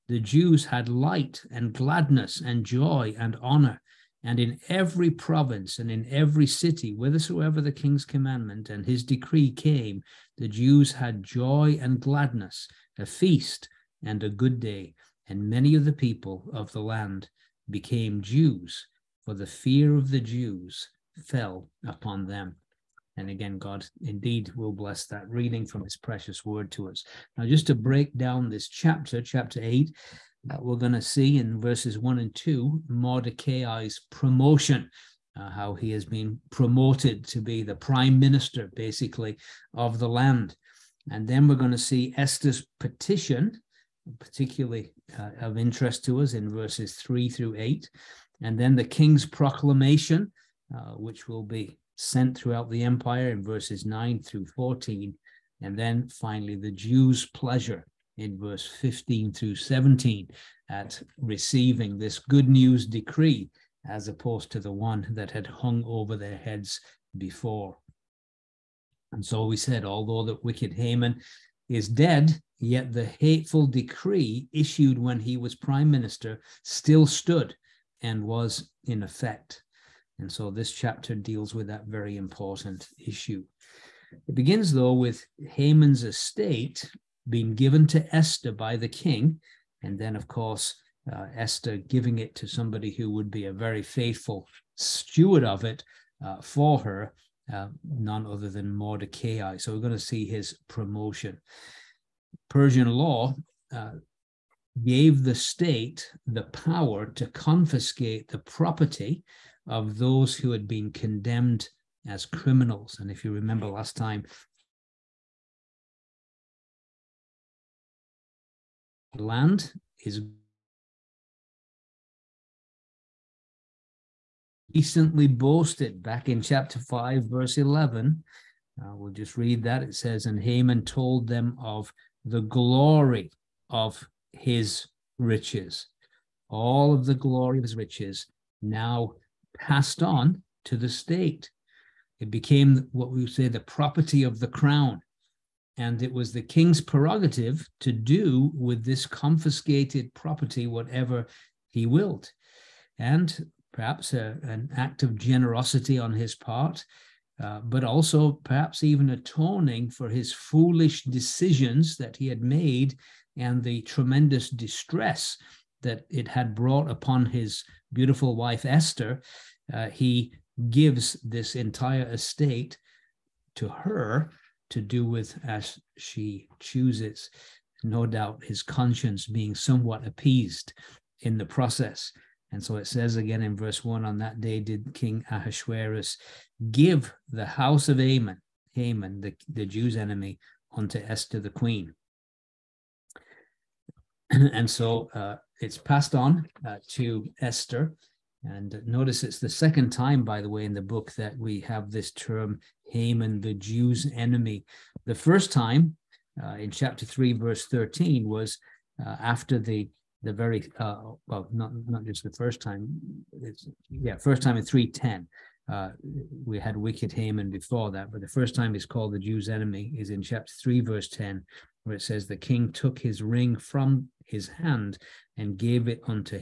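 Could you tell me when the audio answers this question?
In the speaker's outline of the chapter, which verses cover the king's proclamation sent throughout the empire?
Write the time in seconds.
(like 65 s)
53 s.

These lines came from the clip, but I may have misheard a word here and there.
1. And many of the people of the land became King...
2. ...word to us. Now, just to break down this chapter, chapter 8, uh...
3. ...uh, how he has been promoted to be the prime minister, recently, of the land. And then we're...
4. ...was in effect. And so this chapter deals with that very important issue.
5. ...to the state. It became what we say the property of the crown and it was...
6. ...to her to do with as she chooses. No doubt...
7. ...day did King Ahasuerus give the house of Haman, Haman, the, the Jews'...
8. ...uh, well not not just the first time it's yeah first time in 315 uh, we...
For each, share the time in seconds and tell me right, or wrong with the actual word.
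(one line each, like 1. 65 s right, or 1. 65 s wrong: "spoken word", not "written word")
1. 15 s wrong: "Jews", not "King"
2. 26 s right
3. 35 s wrong: "basically", not "recently"
4. 78 s right
5. 140 s right
6. 173 s right
7. 184 s right
8. 210 s wrong: "310", not "315".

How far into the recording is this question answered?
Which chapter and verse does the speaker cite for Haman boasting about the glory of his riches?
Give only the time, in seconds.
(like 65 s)
126 s.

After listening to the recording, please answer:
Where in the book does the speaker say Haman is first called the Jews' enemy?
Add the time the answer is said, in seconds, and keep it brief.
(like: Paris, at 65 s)
Chapter 3, verse 10, at 220 s.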